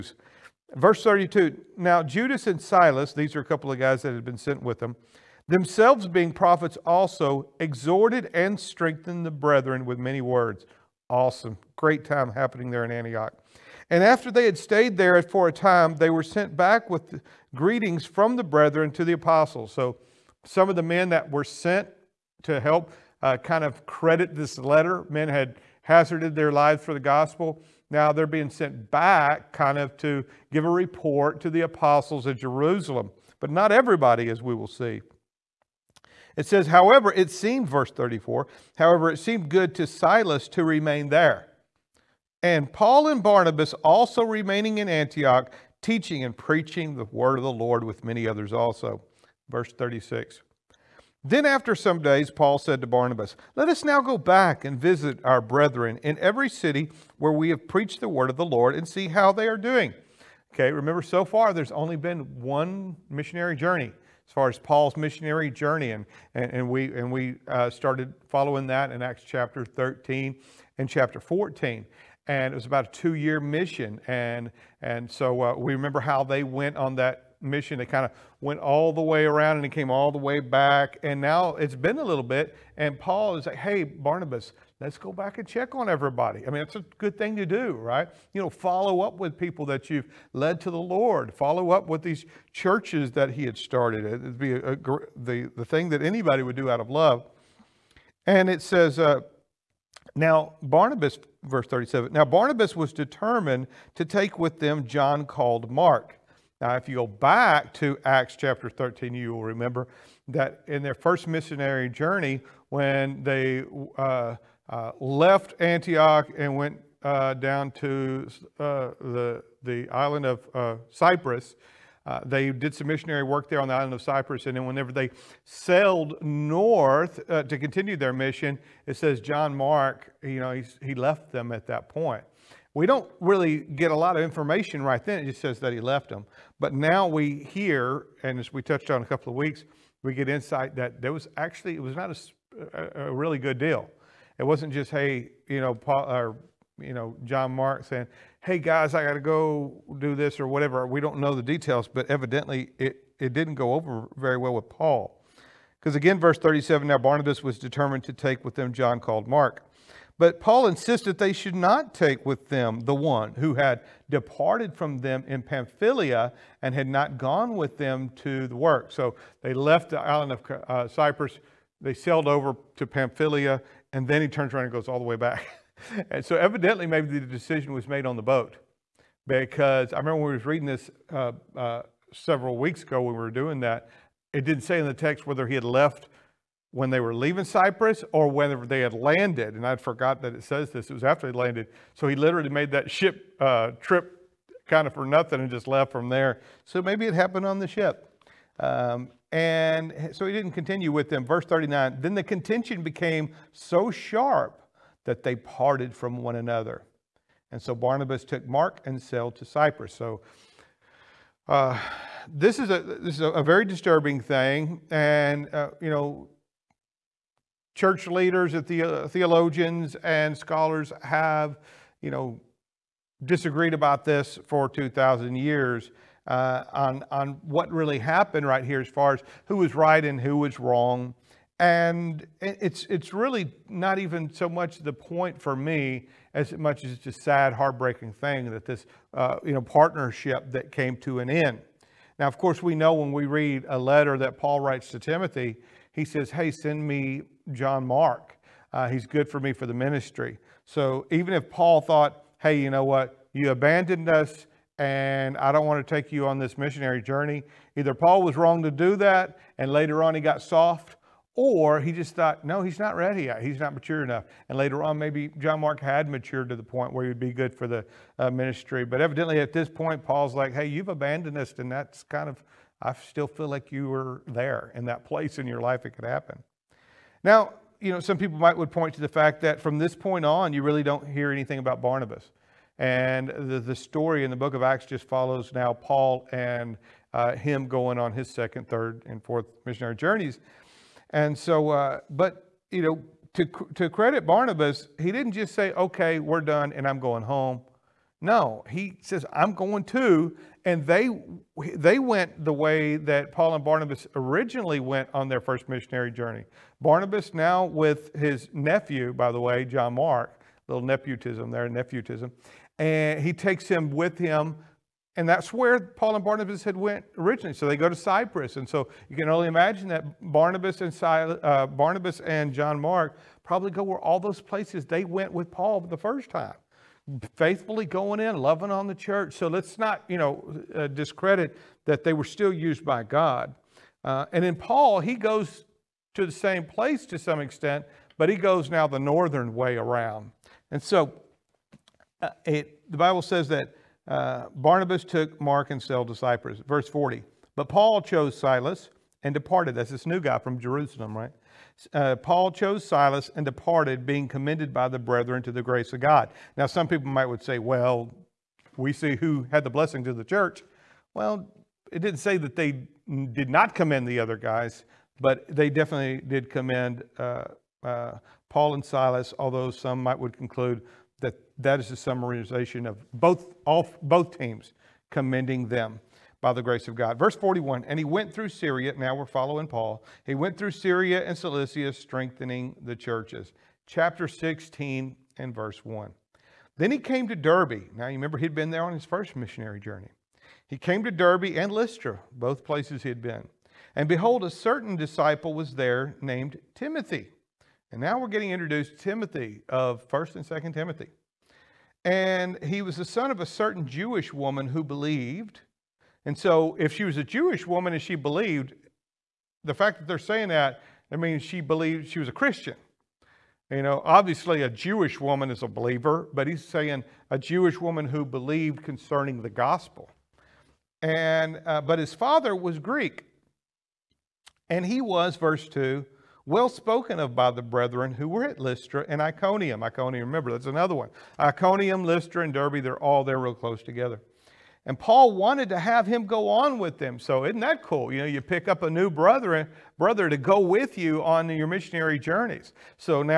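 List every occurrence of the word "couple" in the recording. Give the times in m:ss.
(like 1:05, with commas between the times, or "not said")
0:03, 2:19.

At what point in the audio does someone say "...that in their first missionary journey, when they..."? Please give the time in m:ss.
1:50.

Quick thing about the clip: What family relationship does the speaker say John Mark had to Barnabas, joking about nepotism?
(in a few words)
Nephew.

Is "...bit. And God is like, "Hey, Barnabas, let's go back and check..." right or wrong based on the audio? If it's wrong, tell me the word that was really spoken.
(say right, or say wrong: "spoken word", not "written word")
wrong: "Paul", not "God".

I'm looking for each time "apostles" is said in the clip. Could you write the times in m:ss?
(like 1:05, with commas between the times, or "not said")
0:19, 0:31.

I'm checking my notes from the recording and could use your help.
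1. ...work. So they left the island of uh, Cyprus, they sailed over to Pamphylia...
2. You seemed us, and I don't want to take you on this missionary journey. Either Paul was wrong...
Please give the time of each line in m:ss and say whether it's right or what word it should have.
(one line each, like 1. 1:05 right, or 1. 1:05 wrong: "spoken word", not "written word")
1. 2:48 right
2. 4:13 wrong: "abandoned", not "seemed".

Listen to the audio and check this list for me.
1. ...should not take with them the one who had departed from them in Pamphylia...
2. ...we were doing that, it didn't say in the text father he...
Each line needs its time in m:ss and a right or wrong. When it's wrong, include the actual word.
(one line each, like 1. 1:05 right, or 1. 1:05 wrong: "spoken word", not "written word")
1. 2:41 right
2. 3:03 wrong: "whether", not "father".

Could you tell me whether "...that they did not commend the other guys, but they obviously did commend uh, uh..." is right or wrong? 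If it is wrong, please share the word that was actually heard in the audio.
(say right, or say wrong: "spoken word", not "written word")
wrong: "definitely", not "obviously".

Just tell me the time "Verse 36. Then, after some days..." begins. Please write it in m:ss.
0:49.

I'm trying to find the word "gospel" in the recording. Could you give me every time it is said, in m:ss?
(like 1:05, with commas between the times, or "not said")
0:26, 6:59.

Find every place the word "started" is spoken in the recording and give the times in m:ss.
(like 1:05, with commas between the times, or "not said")
1:07, 1:33.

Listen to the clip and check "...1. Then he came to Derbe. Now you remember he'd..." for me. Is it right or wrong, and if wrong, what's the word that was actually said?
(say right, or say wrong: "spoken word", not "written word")
right.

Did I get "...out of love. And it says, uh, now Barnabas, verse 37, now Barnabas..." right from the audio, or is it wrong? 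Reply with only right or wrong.
right.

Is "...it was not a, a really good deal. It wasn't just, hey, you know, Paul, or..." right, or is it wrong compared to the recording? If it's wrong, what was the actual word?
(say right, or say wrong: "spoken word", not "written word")
right.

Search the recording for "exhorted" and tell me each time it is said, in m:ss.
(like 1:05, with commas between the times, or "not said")
0:07.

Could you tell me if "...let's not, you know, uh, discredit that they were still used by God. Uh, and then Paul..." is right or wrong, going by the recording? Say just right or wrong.
right.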